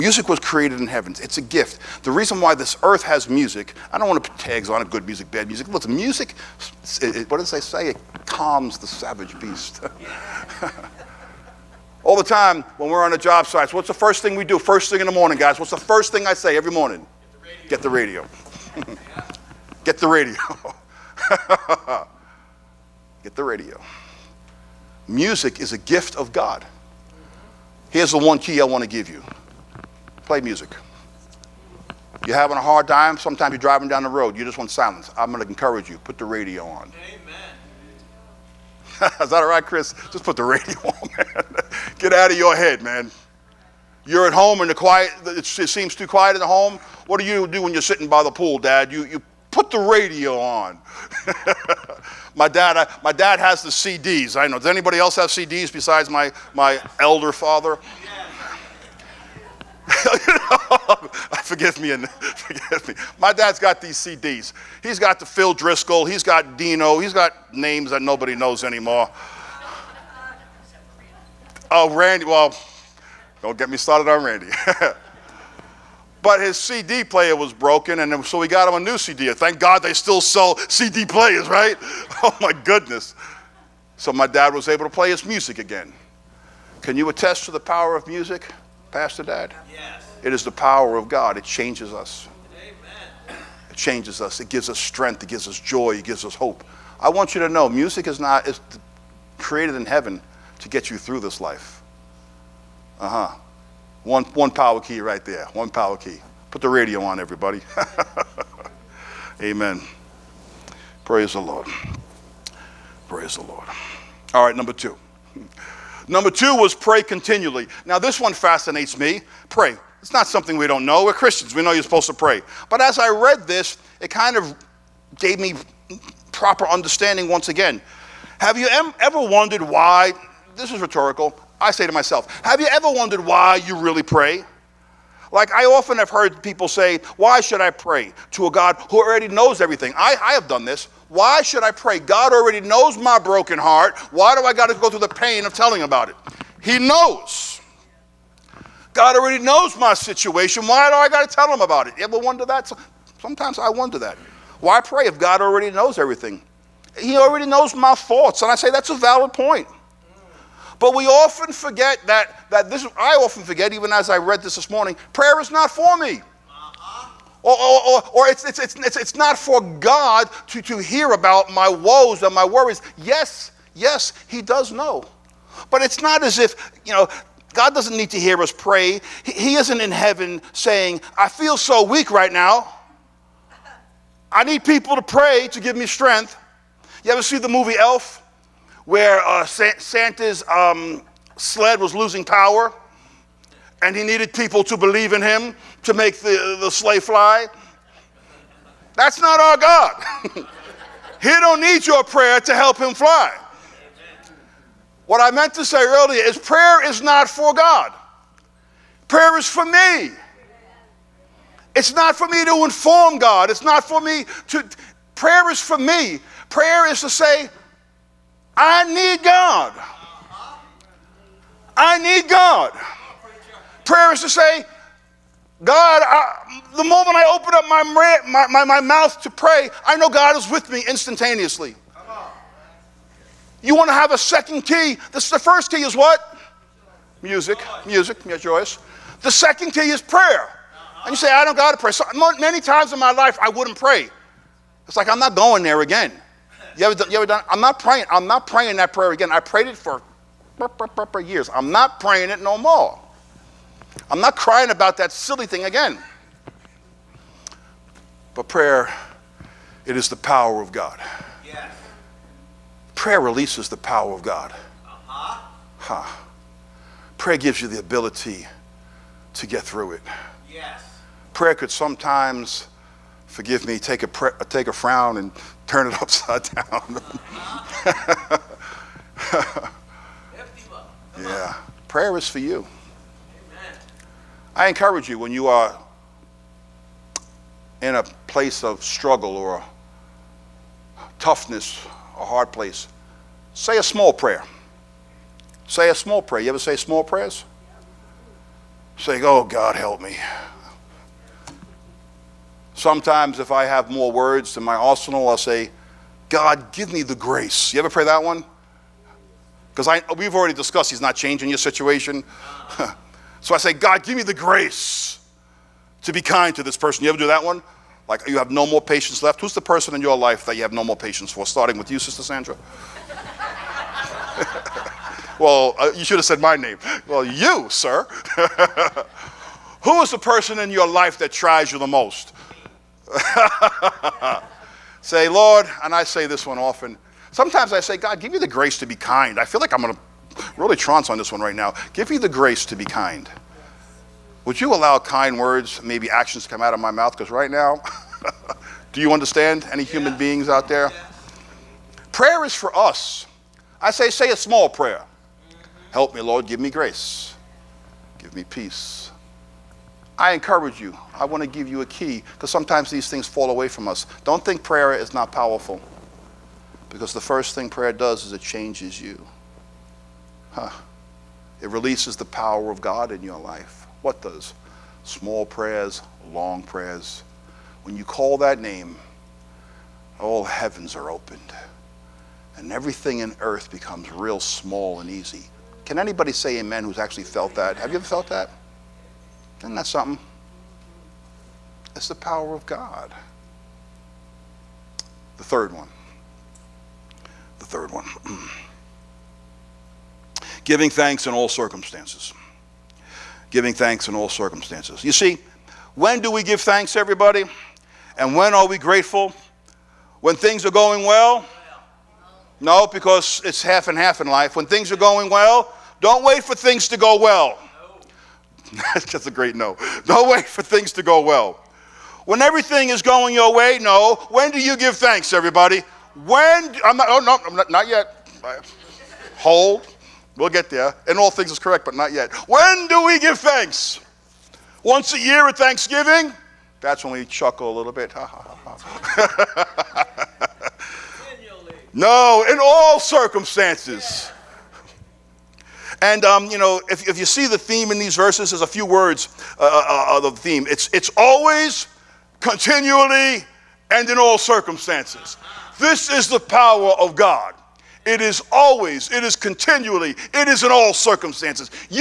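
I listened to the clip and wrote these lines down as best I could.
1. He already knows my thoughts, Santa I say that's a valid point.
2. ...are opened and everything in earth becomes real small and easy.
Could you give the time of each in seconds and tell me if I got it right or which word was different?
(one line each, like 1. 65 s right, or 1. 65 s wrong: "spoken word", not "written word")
1. 156 s wrong: "And", not "Santa"
2. 380 s right.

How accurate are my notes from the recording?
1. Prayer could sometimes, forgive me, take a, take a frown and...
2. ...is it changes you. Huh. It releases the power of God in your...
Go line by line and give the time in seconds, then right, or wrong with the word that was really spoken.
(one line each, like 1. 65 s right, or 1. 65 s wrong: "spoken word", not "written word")
1. 271 s right
2. 368 s right.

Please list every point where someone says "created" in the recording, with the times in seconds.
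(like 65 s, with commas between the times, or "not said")
0 s, 99 s.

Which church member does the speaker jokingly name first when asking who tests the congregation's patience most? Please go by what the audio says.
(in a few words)
Sister Sandra.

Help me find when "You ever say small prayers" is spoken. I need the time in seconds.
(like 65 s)
296 s.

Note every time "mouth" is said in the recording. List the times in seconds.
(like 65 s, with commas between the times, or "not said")
228 s, 346 s.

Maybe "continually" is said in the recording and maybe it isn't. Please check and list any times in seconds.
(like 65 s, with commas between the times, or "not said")
117 s, 452 s, 459 s.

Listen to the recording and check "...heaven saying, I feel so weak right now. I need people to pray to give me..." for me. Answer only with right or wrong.
right.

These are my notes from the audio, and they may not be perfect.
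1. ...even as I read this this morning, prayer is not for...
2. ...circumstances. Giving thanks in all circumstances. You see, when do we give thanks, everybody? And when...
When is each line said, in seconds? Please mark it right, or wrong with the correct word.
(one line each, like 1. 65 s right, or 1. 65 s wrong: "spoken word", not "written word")
1. 163 s right
2. 401 s right.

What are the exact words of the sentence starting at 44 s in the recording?
You're at home and the quiet.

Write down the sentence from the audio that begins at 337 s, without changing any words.
Sometimes I say, God, give me the grace to be kind.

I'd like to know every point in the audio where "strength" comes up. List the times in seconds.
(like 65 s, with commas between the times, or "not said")
94 s, 185 s.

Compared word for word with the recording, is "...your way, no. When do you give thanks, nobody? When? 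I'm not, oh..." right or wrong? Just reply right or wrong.
wrong.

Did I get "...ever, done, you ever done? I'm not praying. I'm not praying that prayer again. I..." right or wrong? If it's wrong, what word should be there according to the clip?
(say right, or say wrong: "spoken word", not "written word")
right.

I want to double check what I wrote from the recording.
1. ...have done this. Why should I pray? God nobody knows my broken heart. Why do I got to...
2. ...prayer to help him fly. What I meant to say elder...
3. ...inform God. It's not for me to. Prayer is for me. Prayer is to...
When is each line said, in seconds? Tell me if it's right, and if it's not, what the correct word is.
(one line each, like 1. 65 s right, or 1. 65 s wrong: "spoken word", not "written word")
1. 140 s wrong: "already", not "nobody"
2. 202 s wrong: "earlier", not "elder"
3. 212 s right.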